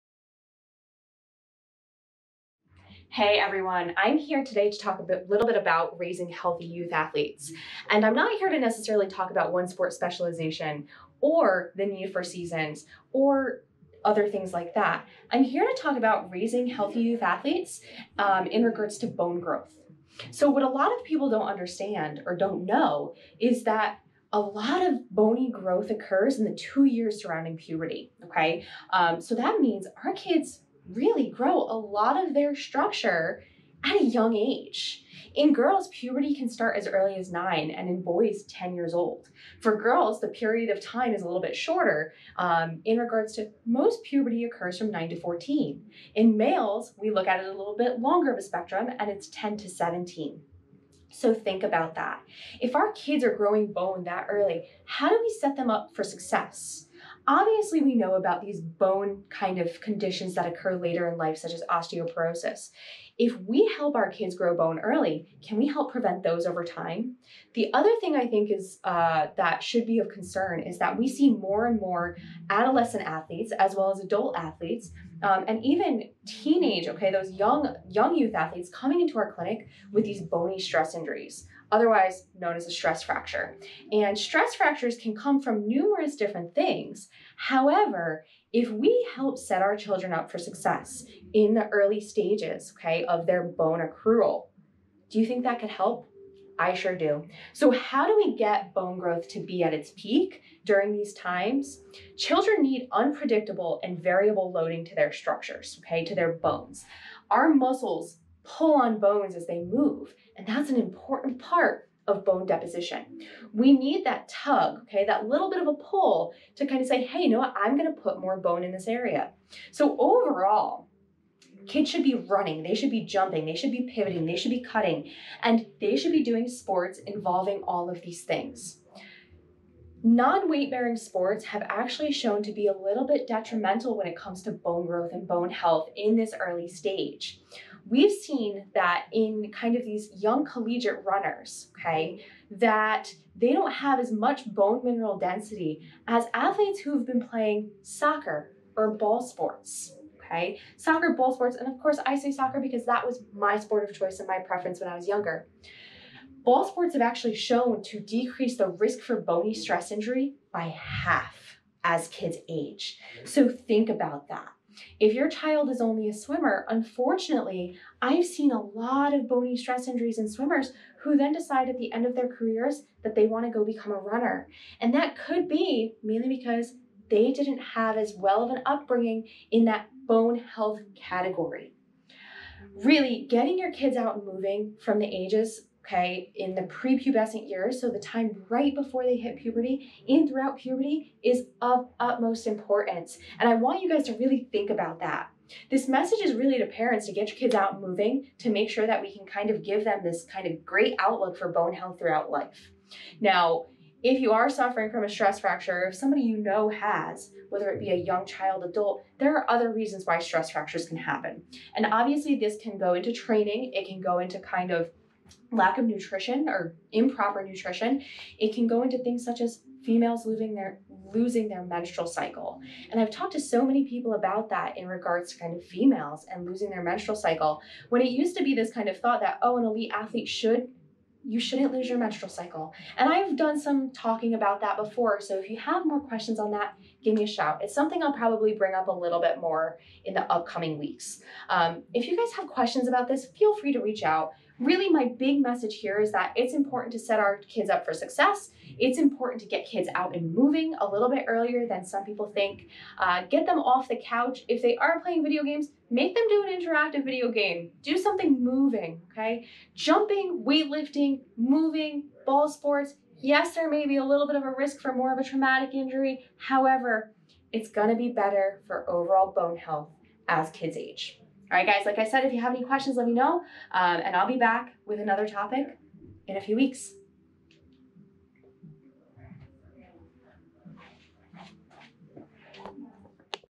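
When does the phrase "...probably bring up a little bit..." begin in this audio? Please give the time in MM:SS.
03:58.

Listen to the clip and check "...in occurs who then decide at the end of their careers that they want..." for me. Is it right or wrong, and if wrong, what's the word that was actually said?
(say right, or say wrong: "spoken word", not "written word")
wrong: "swimmers", not "occurs".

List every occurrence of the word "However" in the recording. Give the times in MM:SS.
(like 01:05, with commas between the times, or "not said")
01:27, 04:26.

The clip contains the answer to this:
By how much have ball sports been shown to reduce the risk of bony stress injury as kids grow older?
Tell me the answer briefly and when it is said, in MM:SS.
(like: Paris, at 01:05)
half, at 02:40.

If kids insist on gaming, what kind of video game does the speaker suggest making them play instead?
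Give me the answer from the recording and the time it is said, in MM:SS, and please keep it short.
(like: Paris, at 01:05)
interactive video game, at 04:16.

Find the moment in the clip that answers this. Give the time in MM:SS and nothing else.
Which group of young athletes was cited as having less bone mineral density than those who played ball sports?
02:20.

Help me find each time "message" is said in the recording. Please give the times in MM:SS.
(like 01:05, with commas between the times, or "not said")
03:15, 04:05.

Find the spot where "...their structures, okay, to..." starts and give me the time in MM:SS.
01:44.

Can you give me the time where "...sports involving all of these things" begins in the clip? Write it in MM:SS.
02:06.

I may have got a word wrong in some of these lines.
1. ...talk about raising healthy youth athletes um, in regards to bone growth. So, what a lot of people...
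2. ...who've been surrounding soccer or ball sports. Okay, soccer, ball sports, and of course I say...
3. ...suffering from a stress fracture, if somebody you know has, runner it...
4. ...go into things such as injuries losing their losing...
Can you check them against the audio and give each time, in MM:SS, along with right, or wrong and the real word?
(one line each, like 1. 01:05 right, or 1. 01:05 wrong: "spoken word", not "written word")
1. 00:15 right
2. 02:26 wrong: "playing", not "surrounding"
3. 03:24 wrong: "whether", not "runner"
4. 03:38 wrong: "females", not "injuries".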